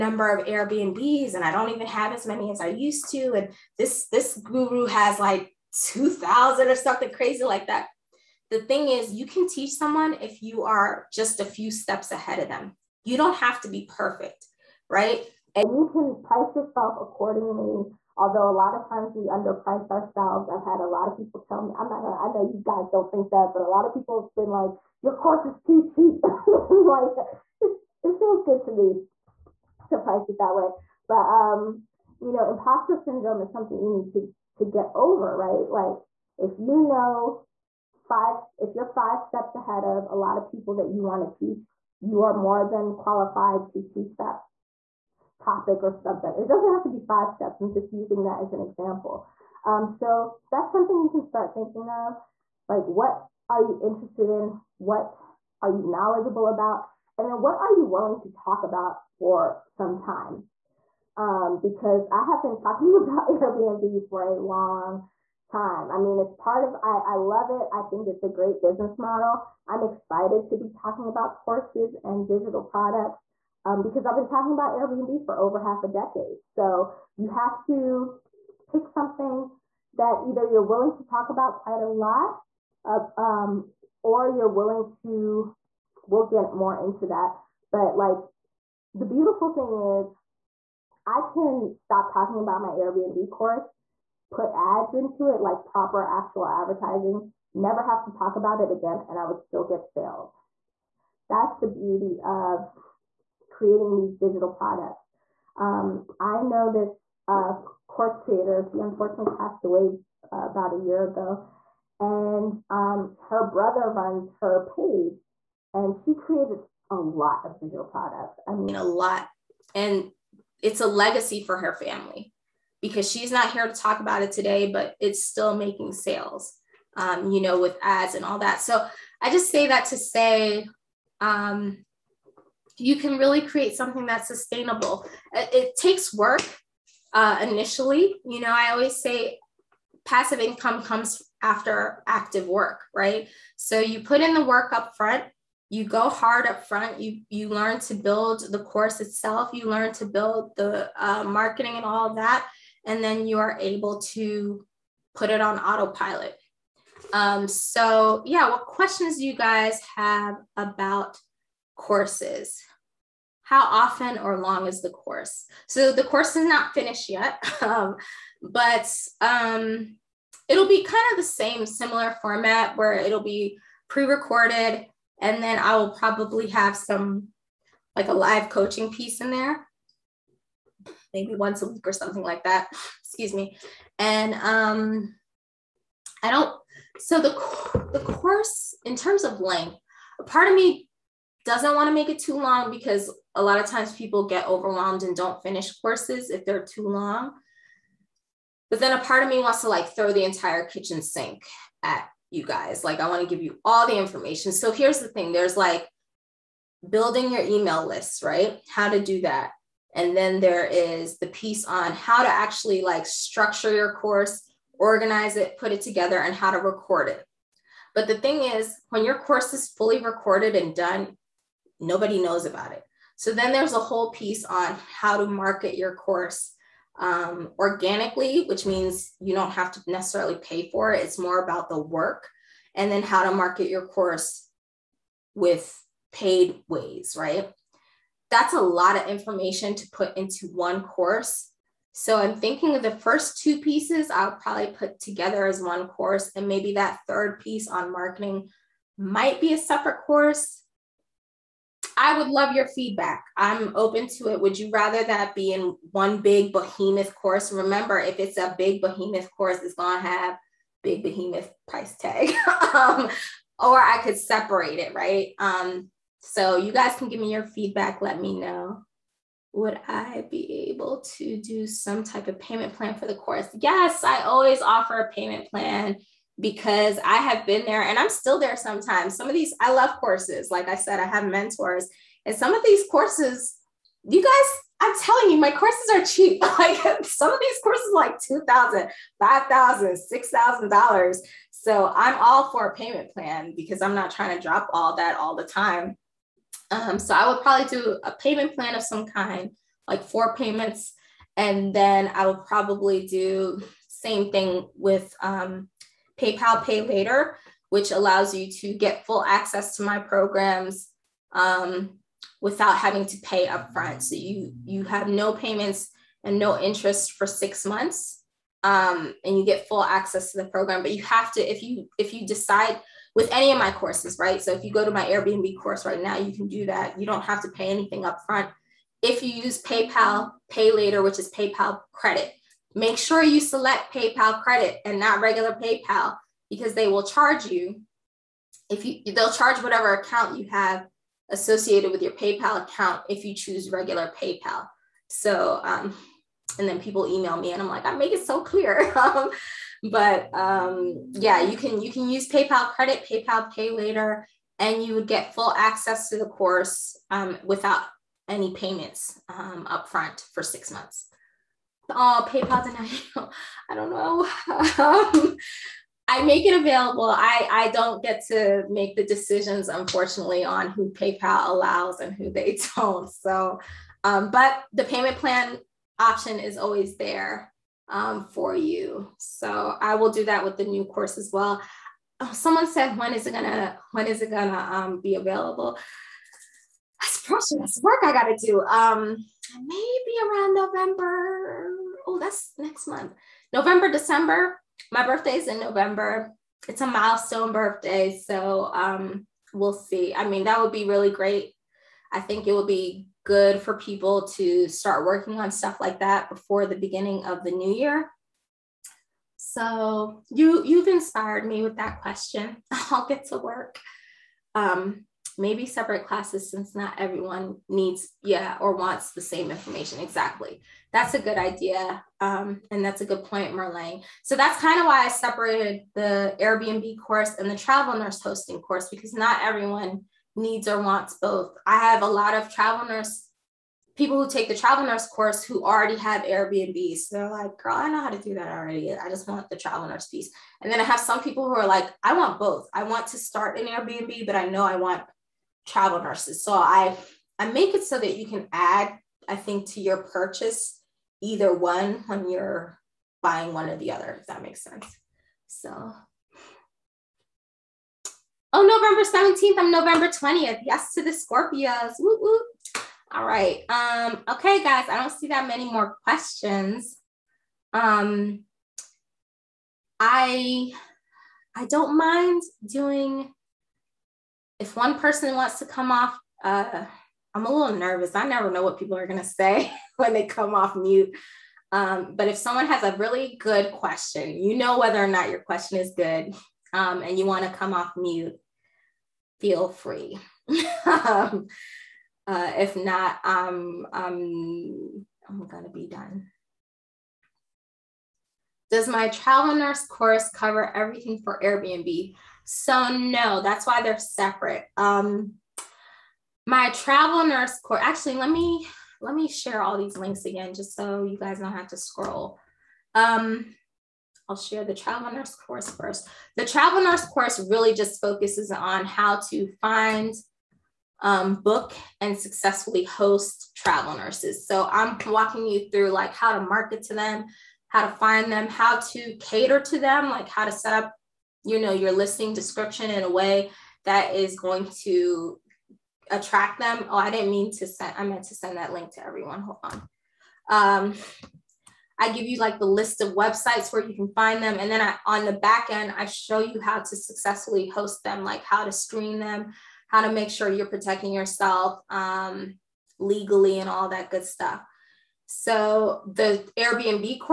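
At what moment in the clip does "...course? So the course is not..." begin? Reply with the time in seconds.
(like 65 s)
164 s.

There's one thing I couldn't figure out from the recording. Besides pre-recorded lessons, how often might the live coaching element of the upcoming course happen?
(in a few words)
once a week.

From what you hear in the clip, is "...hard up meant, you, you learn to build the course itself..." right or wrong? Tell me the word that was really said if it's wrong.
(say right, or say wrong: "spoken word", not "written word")
wrong: "front", not "meant".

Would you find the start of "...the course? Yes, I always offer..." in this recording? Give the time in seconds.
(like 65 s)
273 s.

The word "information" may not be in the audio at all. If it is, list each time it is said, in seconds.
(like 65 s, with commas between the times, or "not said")
203 s, 239 s, 419 s.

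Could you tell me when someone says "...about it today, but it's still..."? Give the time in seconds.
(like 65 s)
124 s.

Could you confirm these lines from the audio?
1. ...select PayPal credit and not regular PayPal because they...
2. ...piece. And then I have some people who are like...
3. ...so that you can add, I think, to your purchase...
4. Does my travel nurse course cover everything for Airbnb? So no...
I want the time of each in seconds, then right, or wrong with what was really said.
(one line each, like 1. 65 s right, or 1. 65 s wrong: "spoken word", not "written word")
1. 333 s right
2. 440 s right
3. 447 s right
4. 498 s right.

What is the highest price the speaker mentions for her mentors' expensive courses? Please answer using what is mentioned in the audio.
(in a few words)
$6,000.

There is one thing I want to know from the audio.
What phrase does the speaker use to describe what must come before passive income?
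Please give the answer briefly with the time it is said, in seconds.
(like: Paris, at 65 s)
active work, at 142 s.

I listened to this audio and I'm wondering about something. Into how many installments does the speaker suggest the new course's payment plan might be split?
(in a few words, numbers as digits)
4.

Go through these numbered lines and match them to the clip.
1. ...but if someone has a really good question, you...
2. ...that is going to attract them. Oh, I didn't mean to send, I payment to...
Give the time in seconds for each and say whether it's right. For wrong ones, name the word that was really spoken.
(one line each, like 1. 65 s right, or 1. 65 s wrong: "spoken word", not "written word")
1. 482 s right
2. 533 s wrong: "meant", not "payment".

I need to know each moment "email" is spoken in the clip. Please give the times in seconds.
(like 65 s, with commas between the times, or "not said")
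207 s, 347 s.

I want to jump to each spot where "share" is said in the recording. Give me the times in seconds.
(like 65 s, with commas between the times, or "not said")
509 s, 514 s.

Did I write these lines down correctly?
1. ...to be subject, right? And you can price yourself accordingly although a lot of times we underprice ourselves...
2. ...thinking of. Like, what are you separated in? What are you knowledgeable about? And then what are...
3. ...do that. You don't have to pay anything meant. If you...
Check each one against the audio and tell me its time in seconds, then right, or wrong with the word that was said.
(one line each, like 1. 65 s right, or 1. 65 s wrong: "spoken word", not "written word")
1. 13 s wrong: "perfect", not "subject"
2. 51 s wrong: "interested", not "separated"
3. 326 s wrong: "upfront", not "meant".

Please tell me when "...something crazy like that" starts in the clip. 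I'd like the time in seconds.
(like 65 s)
6 s.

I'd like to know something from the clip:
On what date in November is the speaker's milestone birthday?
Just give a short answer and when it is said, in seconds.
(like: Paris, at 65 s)
November 20th, at 459 s.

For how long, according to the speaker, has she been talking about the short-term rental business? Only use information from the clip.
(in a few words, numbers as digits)
over half a decade.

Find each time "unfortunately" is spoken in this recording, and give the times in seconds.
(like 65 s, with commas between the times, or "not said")
108 s, 369 s.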